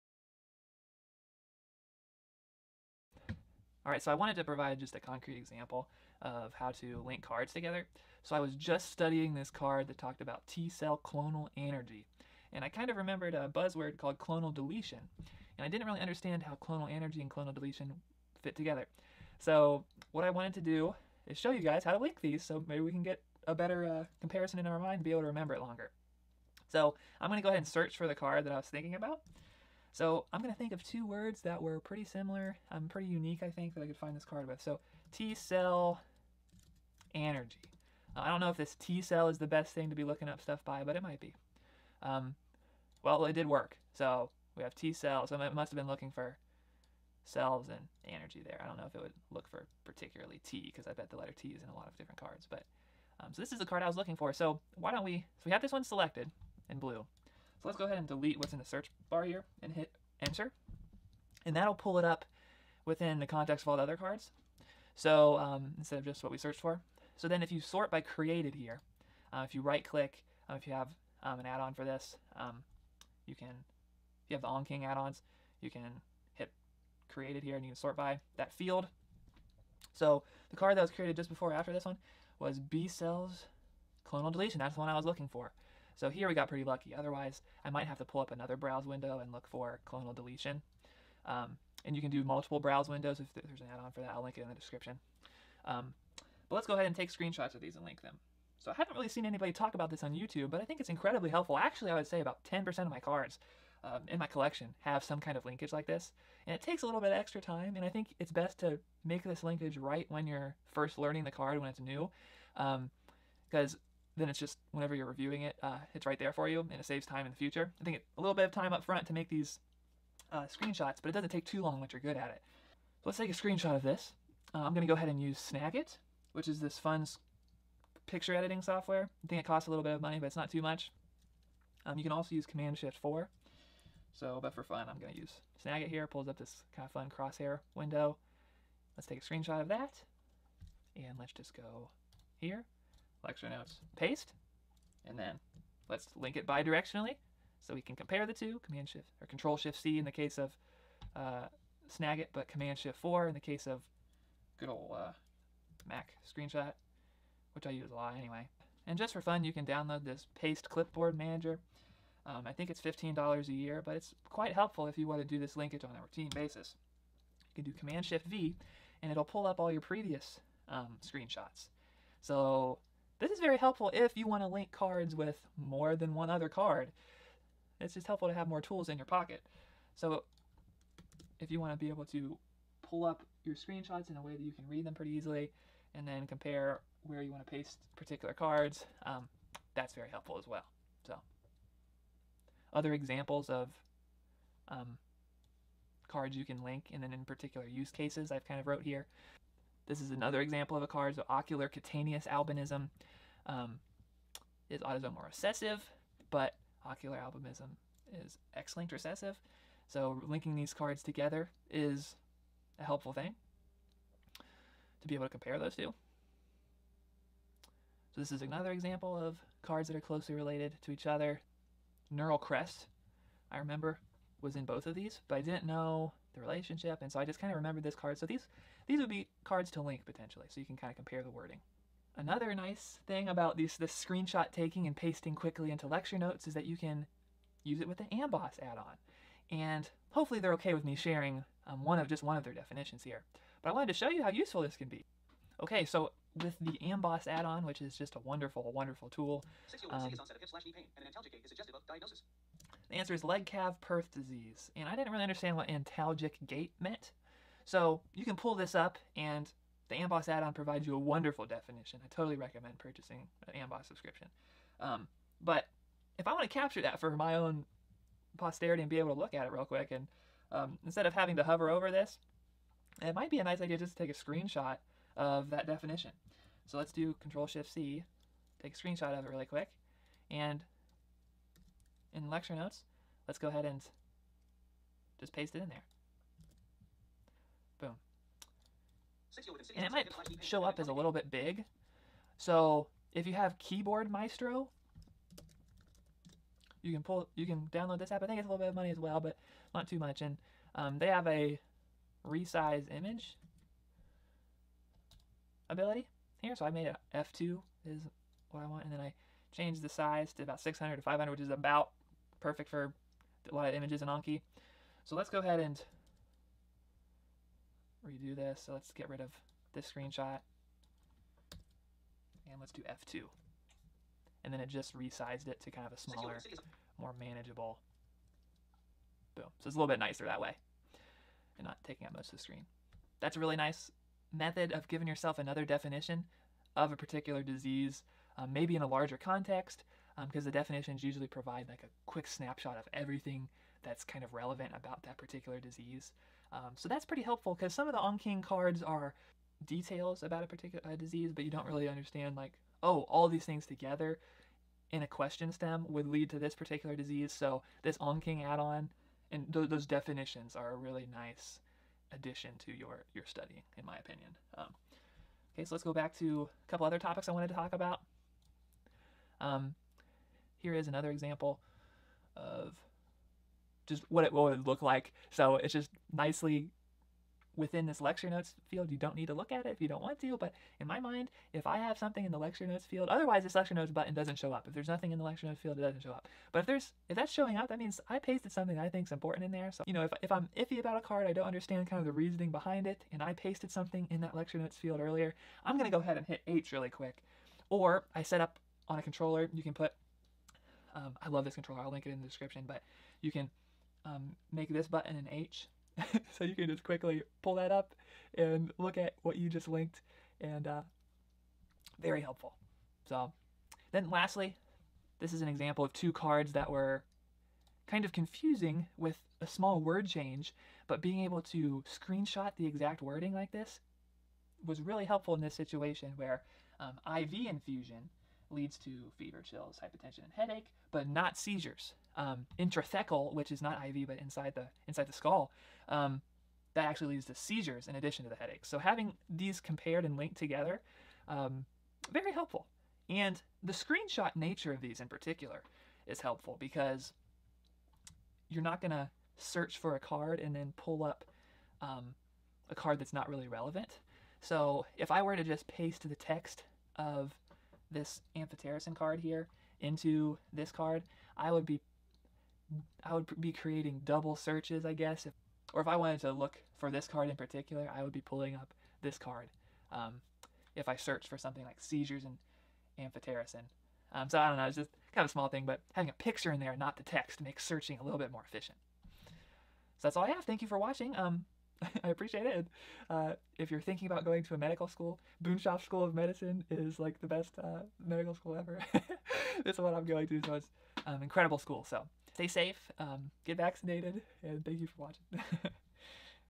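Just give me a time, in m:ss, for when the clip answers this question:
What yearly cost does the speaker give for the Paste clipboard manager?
2:42.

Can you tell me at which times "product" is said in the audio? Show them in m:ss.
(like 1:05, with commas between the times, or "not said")
not said.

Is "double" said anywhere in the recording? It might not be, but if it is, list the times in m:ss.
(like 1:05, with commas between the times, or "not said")
7:44.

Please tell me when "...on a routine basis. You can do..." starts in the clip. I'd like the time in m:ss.
2:45.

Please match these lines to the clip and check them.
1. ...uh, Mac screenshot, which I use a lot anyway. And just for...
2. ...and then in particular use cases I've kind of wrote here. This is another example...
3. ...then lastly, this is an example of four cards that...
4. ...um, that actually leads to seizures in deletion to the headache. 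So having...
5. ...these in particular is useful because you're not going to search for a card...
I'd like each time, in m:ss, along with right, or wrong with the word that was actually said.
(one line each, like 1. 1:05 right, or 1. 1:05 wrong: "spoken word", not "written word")
1. 2:34 right
2. 3:16 right
3. 6:53 wrong: "two", not "four"
4. 7:15 wrong: "addition", not "deletion"
5. 7:24 wrong: "helpful", not "useful".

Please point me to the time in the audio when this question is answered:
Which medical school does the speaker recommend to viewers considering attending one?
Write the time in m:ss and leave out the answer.
8:05.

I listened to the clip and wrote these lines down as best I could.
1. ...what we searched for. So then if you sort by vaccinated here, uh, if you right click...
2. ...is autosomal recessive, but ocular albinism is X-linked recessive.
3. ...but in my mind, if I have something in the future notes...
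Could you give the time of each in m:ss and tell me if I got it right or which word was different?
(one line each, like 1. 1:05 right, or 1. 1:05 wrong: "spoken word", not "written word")
1. 1:06 wrong: "created", not "vaccinated"
2. 3:24 right
3. 6:20 wrong: "lecture", not "future".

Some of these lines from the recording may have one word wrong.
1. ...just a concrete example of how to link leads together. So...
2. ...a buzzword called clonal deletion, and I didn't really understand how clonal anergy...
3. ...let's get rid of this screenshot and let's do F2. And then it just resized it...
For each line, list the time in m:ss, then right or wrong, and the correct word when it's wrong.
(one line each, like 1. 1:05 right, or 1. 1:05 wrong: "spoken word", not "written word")
1. 0:04 wrong: "cards", not "leads"
2. 0:13 right
3. 5:18 right.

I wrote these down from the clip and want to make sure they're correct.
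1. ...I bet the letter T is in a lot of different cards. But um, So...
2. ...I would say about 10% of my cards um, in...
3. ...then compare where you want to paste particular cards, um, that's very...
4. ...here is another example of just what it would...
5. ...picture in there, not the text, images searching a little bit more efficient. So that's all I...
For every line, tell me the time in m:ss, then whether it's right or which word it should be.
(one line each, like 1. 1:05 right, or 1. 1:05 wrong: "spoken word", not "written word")
1. 0:50 right
2. 1:41 right
3. 3:06 right
4. 6:10 right
5. 7:56 wrong: "makes", not "images".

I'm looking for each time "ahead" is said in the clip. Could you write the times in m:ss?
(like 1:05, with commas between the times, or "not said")
0:27, 0:57, 1:36, 2:04, 4:43, 5:15, 6:35.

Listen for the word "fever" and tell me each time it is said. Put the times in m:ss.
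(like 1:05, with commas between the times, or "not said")
7:09.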